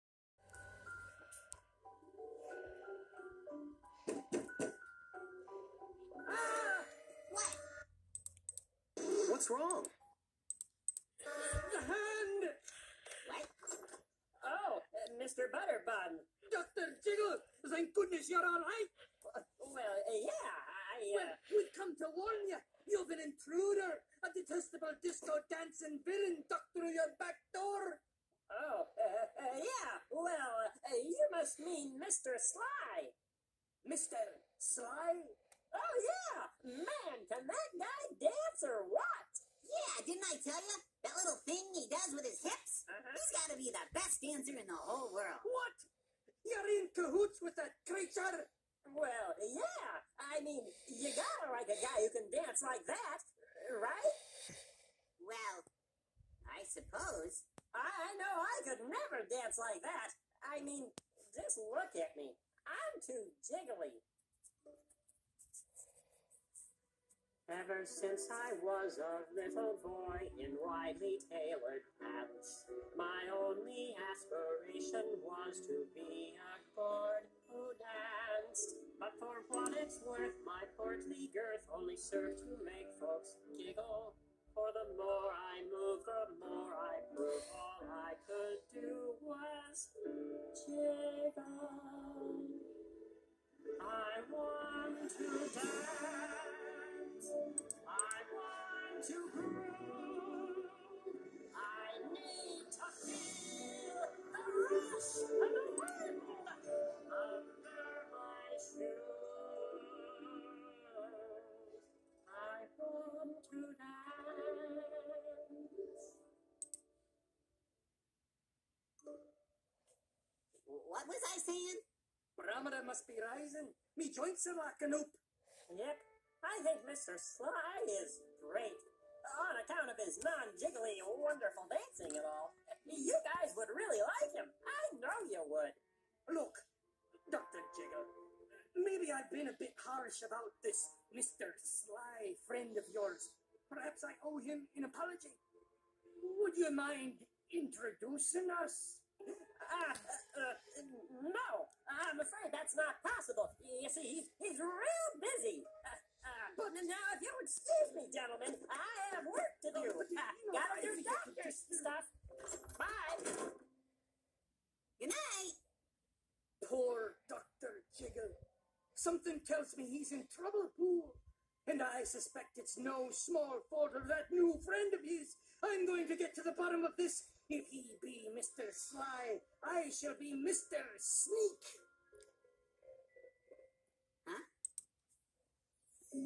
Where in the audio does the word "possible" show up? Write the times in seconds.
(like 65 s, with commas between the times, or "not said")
153 s.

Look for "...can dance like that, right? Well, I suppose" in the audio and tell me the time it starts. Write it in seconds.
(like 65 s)
52 s.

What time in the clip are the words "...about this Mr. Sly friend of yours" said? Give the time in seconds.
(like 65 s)
140 s.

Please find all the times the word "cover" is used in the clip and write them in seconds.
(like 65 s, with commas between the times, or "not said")
not said.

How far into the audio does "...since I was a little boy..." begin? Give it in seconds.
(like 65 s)
67 s.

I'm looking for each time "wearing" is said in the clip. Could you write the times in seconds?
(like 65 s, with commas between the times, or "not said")
not said.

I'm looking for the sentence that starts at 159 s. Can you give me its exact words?
Got to uh, do doctor's stuff.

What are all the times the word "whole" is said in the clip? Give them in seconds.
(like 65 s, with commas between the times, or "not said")
44 s.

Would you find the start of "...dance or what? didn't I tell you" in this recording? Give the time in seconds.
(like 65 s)
38 s.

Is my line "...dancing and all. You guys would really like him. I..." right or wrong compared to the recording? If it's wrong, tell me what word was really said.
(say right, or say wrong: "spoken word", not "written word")
right.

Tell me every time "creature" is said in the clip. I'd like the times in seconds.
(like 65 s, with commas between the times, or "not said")
47 s.